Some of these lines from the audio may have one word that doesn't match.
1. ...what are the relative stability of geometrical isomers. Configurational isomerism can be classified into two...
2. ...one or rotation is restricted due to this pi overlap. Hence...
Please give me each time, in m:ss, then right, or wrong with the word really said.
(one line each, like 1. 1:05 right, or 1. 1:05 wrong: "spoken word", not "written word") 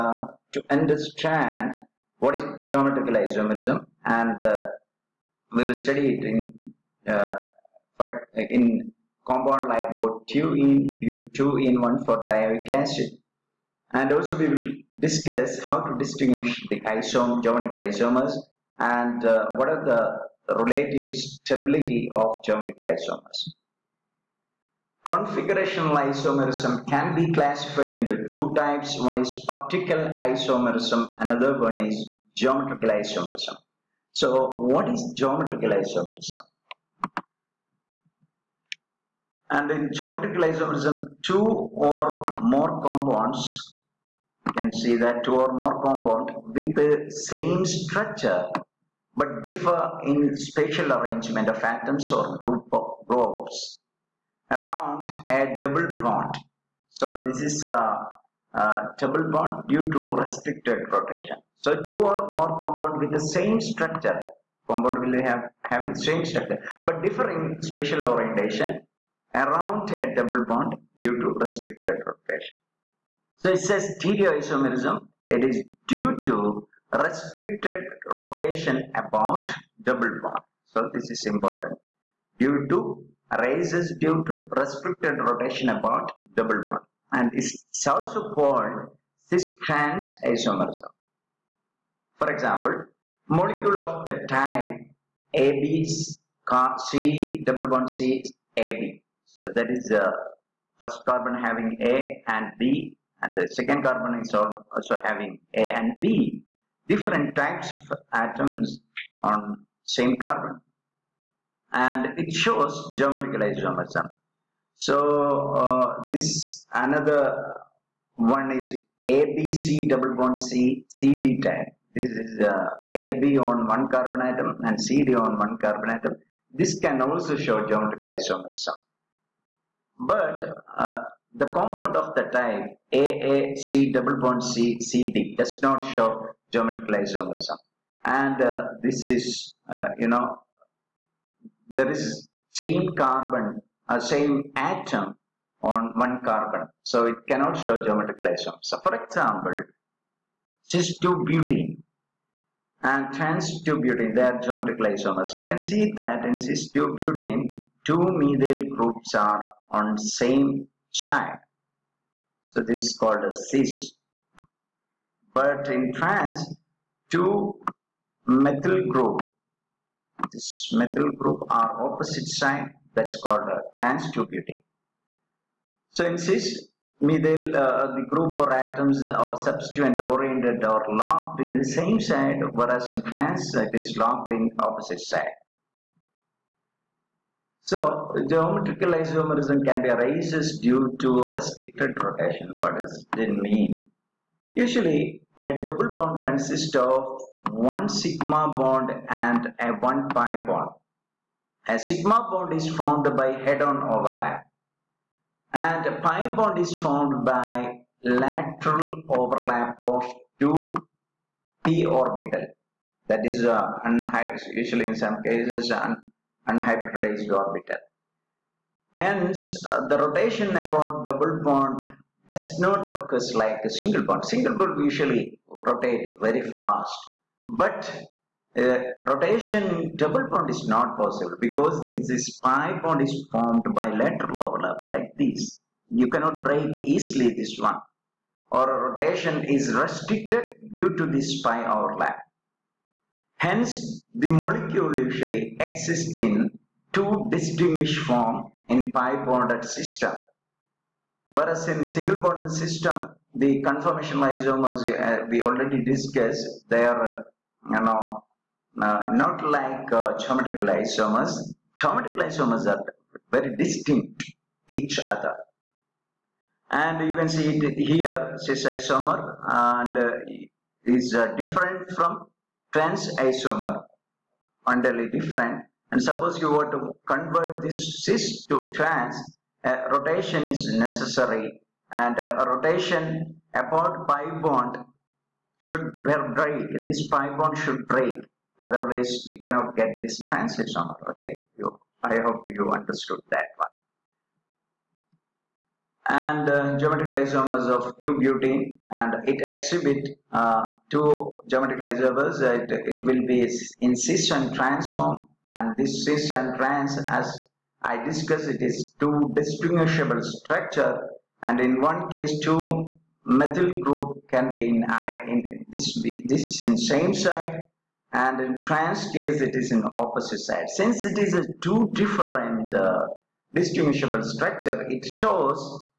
1. 0:19 right
2. 3:57 right.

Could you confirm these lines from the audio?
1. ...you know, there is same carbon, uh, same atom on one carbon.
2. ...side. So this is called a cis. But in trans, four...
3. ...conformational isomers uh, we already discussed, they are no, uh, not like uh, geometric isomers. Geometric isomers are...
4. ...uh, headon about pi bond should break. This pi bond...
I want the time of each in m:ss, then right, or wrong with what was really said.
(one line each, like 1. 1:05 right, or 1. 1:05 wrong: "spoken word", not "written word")
1. 2:19 right
2. 2:40 wrong: "two", not "four"
3. 4:13 right
4. 4:42 wrong: "rotation", not "headon".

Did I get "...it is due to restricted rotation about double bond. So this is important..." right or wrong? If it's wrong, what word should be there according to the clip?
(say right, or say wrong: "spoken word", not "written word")
right.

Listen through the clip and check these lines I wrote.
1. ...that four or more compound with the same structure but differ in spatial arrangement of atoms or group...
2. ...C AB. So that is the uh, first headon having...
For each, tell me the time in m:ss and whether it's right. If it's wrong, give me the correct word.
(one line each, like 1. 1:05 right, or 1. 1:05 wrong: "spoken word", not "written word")
1. 0:44 wrong: "two", not "four"
2. 1:37 wrong: "carbon", not "headon".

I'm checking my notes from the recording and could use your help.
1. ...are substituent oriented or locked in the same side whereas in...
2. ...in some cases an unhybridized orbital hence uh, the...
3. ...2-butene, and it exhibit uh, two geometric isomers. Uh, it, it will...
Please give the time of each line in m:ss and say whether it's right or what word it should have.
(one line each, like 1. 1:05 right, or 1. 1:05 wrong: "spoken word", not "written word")
1. 2:59 right
2. 3:34 right
3. 4:57 right.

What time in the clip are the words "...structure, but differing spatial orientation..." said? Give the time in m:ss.
1:06.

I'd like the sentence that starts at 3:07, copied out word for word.
So geometrical isomerism can be arises due to restricted rotation.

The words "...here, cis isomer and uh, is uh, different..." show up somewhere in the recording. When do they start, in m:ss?
4:27.